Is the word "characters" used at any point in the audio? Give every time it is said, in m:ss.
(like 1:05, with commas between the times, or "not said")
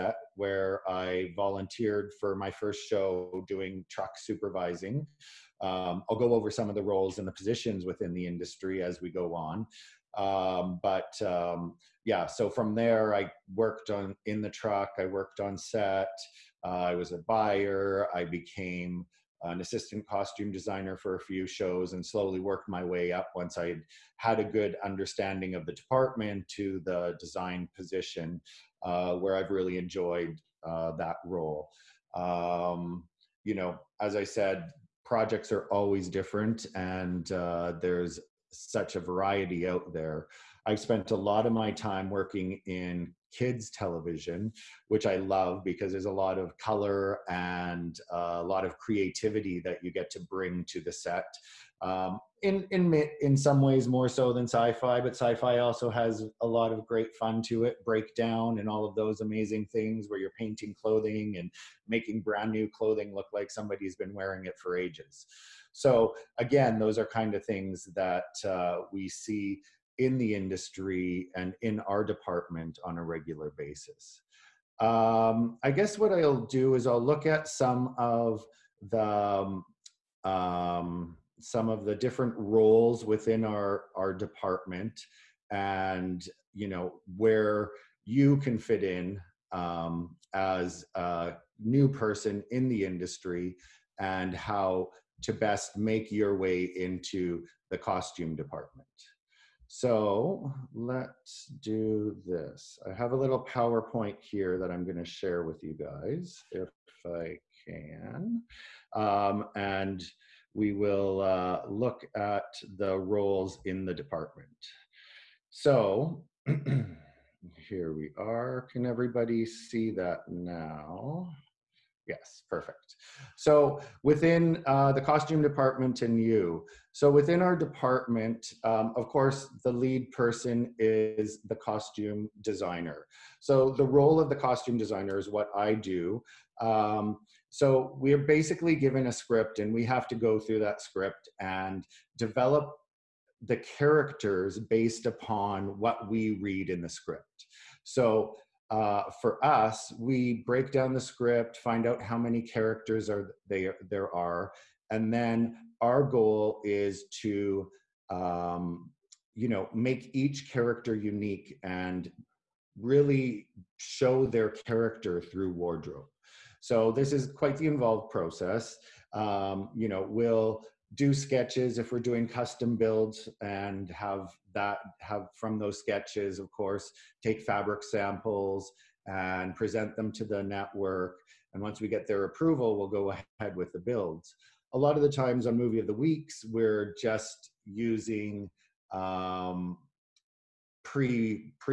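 2:23, 2:32, 2:40, 2:44.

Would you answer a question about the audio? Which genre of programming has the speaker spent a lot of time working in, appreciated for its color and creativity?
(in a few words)
Kids television.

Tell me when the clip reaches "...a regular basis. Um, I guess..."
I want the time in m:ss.
1:12.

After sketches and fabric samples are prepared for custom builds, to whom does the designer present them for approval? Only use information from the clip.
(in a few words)
The network.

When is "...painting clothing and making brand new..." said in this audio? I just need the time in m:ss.
1:00.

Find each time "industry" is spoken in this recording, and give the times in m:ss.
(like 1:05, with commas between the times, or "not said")
0:08, 1:10, 1:32.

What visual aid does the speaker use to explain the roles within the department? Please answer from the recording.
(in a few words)
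PowerPoint.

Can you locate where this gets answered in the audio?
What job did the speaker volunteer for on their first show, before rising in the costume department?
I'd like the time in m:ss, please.
0:03.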